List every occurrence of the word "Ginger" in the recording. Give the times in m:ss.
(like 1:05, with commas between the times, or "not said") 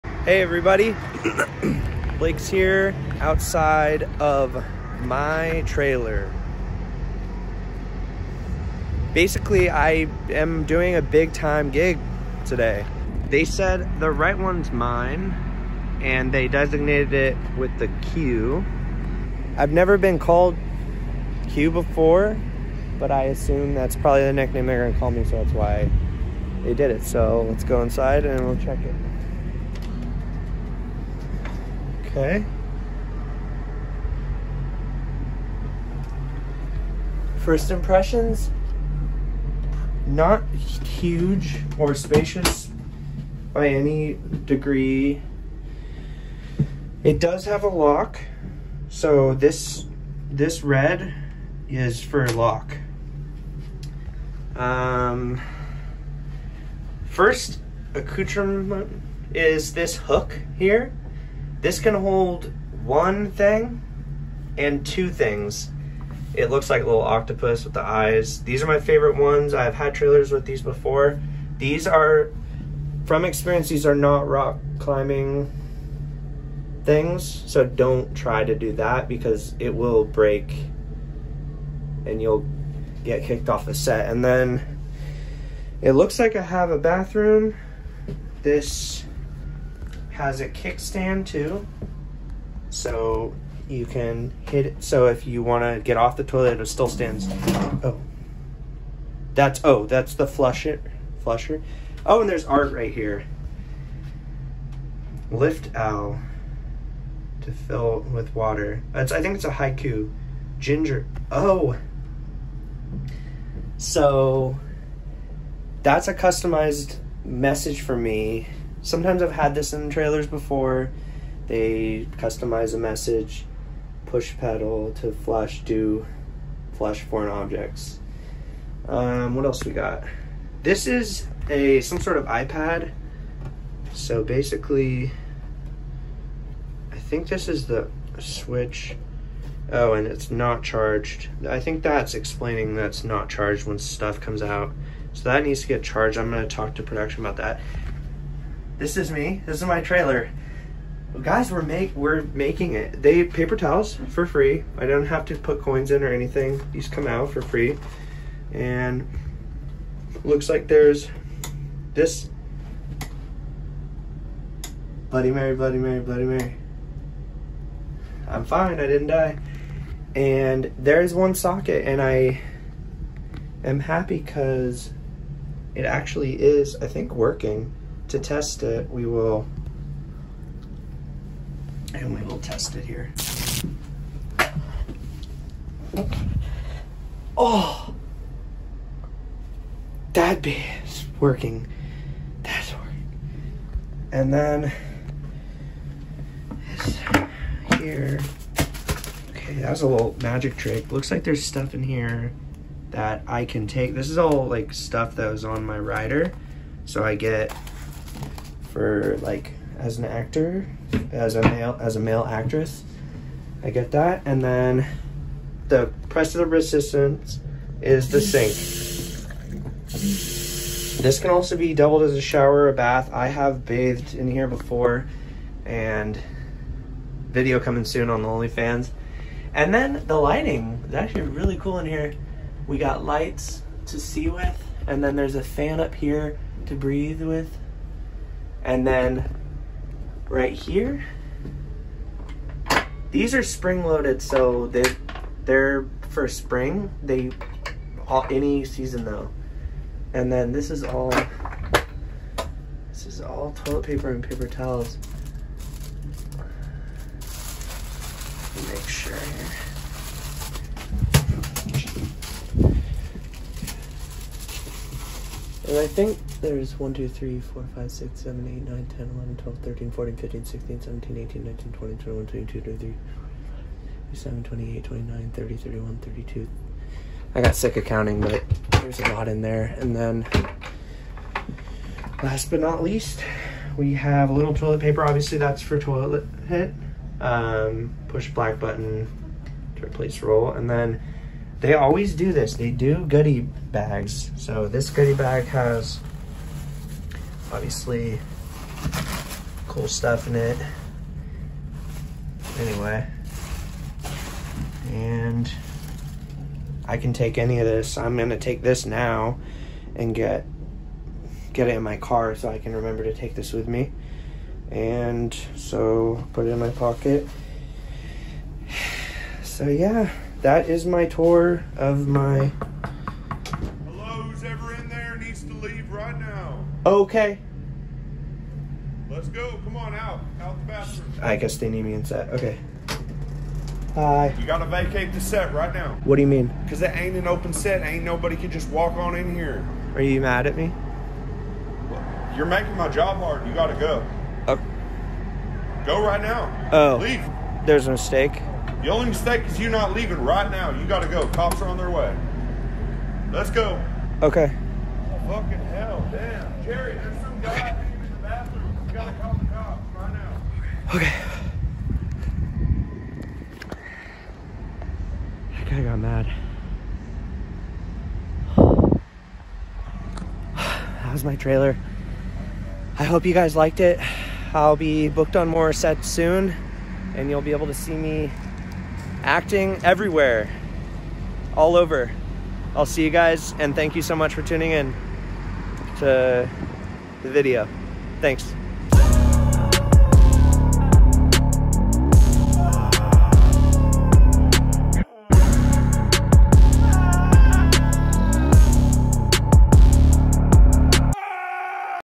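1:50.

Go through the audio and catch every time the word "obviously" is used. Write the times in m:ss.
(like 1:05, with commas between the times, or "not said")
4:45, 4:57.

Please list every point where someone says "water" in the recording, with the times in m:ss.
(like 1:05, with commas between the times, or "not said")
1:48.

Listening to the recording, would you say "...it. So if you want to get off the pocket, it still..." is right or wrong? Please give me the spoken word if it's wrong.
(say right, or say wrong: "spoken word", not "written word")
wrong: "toilet", not "pocket".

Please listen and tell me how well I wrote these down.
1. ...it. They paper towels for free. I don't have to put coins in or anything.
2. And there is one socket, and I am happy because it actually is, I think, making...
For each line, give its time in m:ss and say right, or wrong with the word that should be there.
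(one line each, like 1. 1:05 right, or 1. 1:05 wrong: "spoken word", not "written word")
1. 2:32 right
2. 2:50 wrong: "working", not "making".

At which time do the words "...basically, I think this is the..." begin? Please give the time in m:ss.
2:14.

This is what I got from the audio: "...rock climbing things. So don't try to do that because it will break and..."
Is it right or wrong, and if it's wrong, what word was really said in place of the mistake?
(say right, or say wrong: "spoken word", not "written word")
right.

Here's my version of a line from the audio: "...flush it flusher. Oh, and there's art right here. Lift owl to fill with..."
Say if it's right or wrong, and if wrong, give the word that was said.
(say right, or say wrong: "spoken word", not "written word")
right.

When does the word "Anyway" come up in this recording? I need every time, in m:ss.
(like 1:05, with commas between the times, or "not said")
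5:02.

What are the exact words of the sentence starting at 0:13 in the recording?
They said the right one's mine and they designated it with the Q.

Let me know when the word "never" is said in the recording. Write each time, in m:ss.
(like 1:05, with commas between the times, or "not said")
0:19.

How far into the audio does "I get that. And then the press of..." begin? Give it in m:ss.
3:33.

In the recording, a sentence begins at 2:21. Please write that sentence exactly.
I think that's explaining that's not charged when stuff comes out.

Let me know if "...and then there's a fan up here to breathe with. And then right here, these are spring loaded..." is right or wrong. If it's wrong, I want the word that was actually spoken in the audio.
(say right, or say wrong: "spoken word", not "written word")
right.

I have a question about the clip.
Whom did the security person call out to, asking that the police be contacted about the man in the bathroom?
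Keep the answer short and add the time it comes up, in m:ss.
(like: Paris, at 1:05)
Jerry, at 5:56.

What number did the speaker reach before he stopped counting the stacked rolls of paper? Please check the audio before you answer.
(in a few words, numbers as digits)
32.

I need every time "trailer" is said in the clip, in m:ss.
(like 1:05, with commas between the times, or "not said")
0:05, 1:09, 1:59, 2:29, 6:11.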